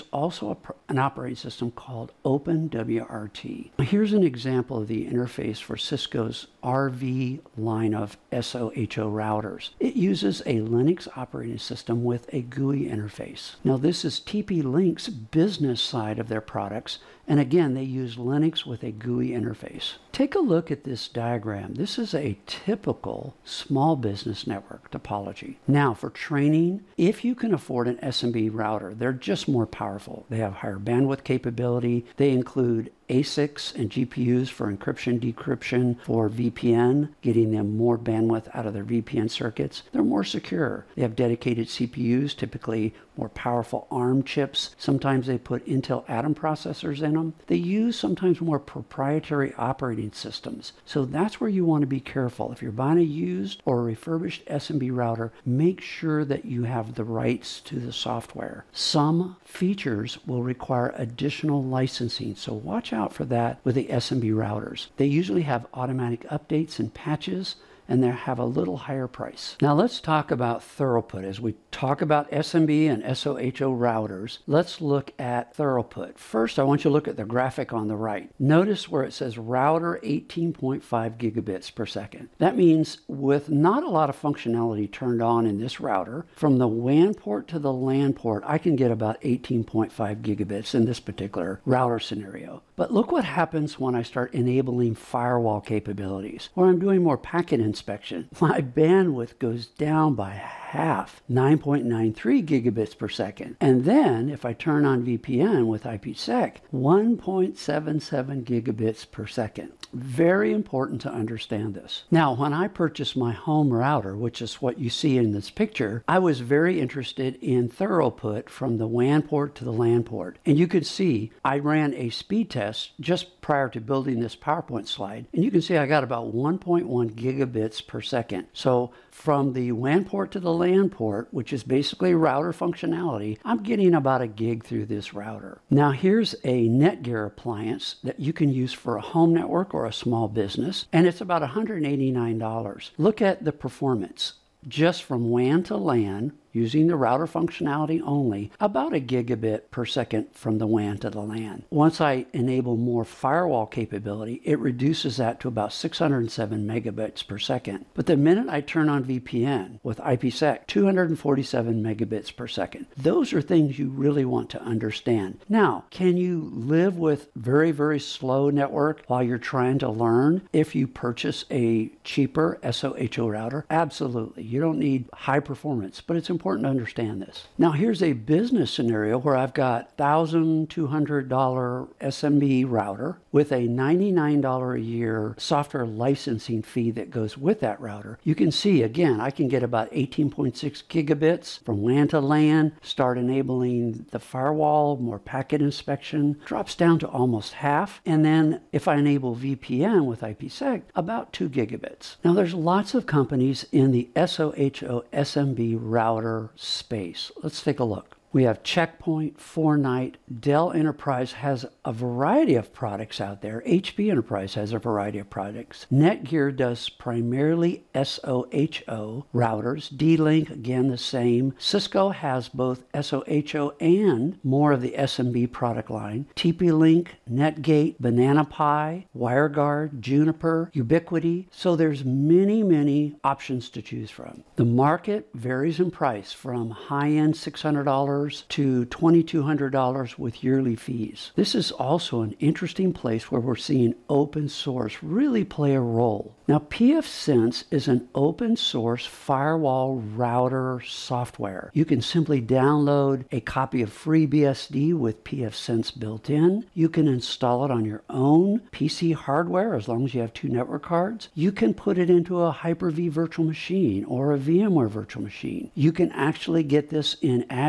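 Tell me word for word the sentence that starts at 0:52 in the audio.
If you're buying a used or a refurbished SMB router, make sure that you have the rights to the software.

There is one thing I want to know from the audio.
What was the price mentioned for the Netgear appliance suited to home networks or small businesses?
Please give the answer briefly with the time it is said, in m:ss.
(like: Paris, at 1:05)
$189, at 2:21.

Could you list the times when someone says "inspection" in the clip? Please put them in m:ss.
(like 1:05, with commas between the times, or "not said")
1:37, 3:15.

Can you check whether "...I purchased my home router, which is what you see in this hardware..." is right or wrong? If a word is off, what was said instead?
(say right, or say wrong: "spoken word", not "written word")
wrong: "picture", not "hardware".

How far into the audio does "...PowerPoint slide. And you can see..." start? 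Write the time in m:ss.
2:04.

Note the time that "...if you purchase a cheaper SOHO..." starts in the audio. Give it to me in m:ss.
2:50.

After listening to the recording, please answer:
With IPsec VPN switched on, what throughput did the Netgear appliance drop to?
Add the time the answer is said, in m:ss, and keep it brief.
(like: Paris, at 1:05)
247 megabits per second, at 2:40.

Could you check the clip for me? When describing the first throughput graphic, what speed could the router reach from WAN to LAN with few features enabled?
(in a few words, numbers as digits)
18.5 gigabits per second.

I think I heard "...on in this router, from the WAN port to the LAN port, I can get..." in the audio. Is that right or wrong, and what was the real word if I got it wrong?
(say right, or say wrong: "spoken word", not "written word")
right.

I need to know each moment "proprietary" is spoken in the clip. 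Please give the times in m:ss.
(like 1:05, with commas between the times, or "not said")
0:48.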